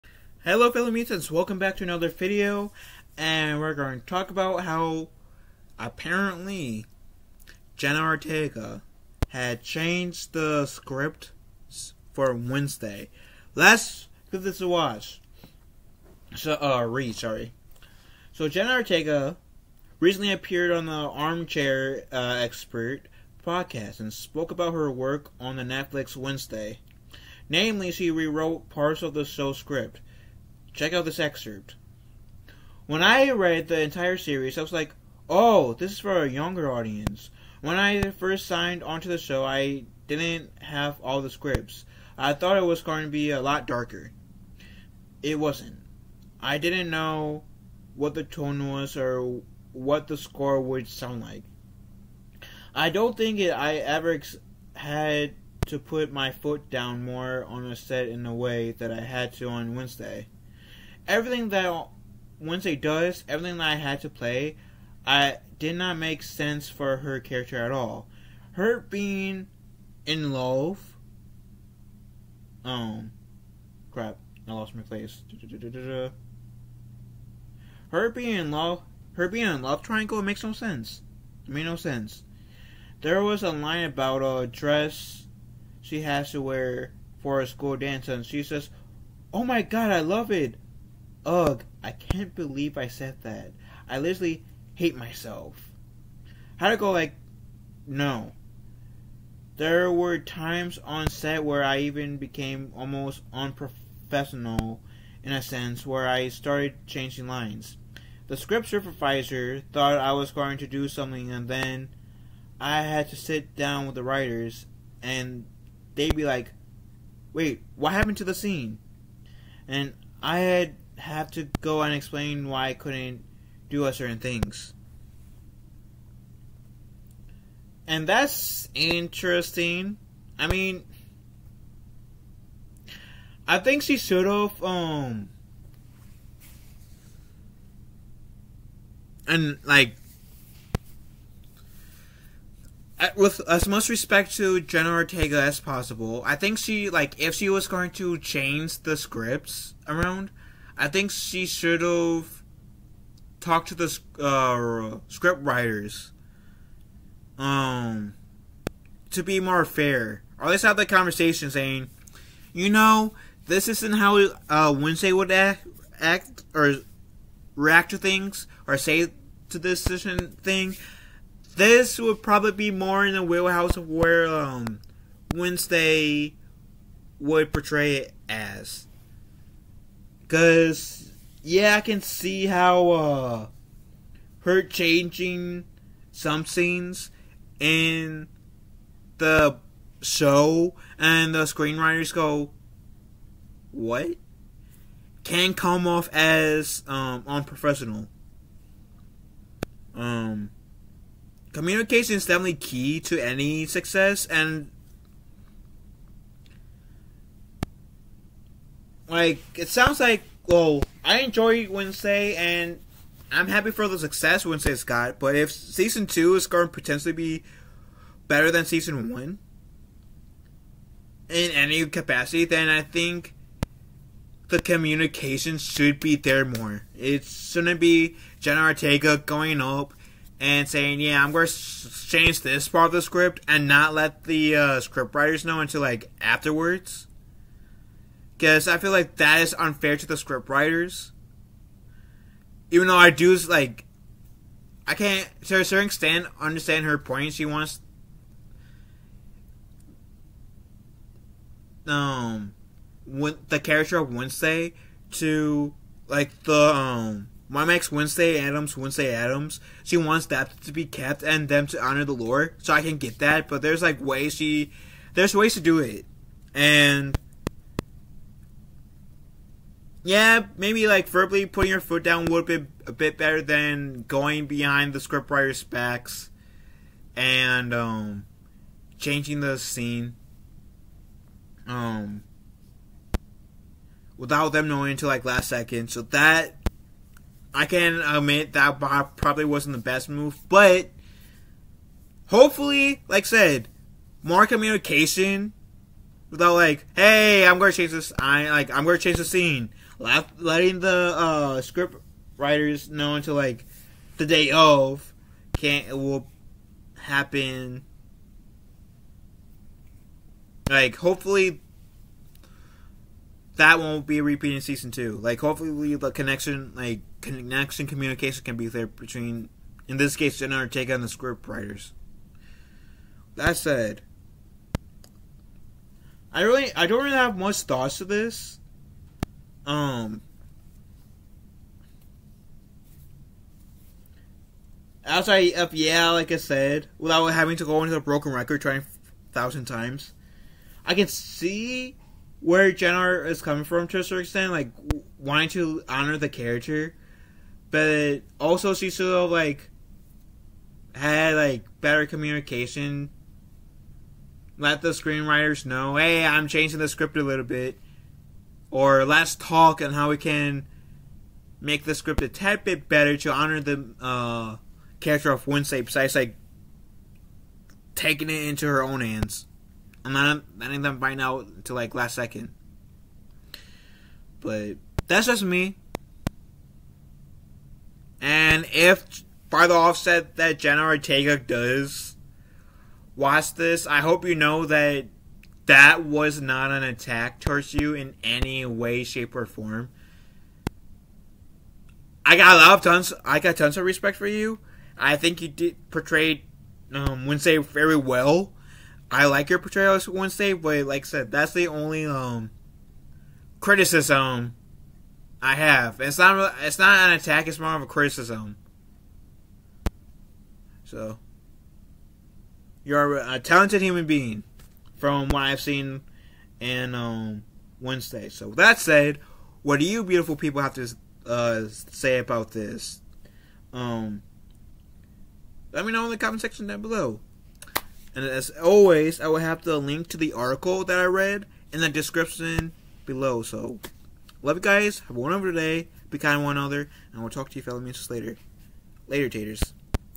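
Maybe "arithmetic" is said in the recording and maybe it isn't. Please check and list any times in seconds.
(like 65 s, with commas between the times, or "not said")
not said.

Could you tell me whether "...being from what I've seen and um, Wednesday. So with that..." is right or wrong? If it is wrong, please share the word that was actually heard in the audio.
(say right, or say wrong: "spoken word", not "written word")
right.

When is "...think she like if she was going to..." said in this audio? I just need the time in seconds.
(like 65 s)
146 s.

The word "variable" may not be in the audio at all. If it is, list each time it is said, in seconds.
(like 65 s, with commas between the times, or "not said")
not said.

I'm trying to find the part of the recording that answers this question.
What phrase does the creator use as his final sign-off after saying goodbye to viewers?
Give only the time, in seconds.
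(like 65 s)
439 s.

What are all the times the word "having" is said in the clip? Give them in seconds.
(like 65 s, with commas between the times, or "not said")
337 s.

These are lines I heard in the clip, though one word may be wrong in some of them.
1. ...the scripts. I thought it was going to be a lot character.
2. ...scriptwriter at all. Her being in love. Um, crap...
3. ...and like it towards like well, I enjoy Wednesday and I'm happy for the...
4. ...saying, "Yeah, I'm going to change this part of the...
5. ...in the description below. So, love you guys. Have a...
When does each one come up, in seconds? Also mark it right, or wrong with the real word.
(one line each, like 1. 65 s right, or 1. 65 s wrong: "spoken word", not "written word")
1. 41 s wrong: "darker", not "character"
2. 67 s wrong: "character", not "scriptwriter"
3. 204 s wrong: "sounds", not "towards"
4. 230 s right
5. 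431 s right.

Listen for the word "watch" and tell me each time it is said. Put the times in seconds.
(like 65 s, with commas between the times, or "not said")
14 s, 383 s.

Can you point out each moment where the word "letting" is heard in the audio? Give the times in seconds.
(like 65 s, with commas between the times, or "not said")
300 s, 370 s.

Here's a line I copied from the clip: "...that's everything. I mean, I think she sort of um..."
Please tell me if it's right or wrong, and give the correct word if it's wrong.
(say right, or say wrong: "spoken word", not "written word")
wrong: "interesting", not "everything".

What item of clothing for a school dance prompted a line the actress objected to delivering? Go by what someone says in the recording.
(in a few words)
a dress.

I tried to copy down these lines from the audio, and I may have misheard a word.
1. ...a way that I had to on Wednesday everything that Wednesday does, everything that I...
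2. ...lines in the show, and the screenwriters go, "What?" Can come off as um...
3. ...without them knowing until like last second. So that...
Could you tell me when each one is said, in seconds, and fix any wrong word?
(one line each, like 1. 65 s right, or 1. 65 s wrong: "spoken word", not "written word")
1. 58 s right
2. 186 s wrong: "scenes", not "lines"
3. 284 s right.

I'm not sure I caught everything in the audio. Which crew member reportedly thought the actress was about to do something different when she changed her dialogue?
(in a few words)
script supervisor.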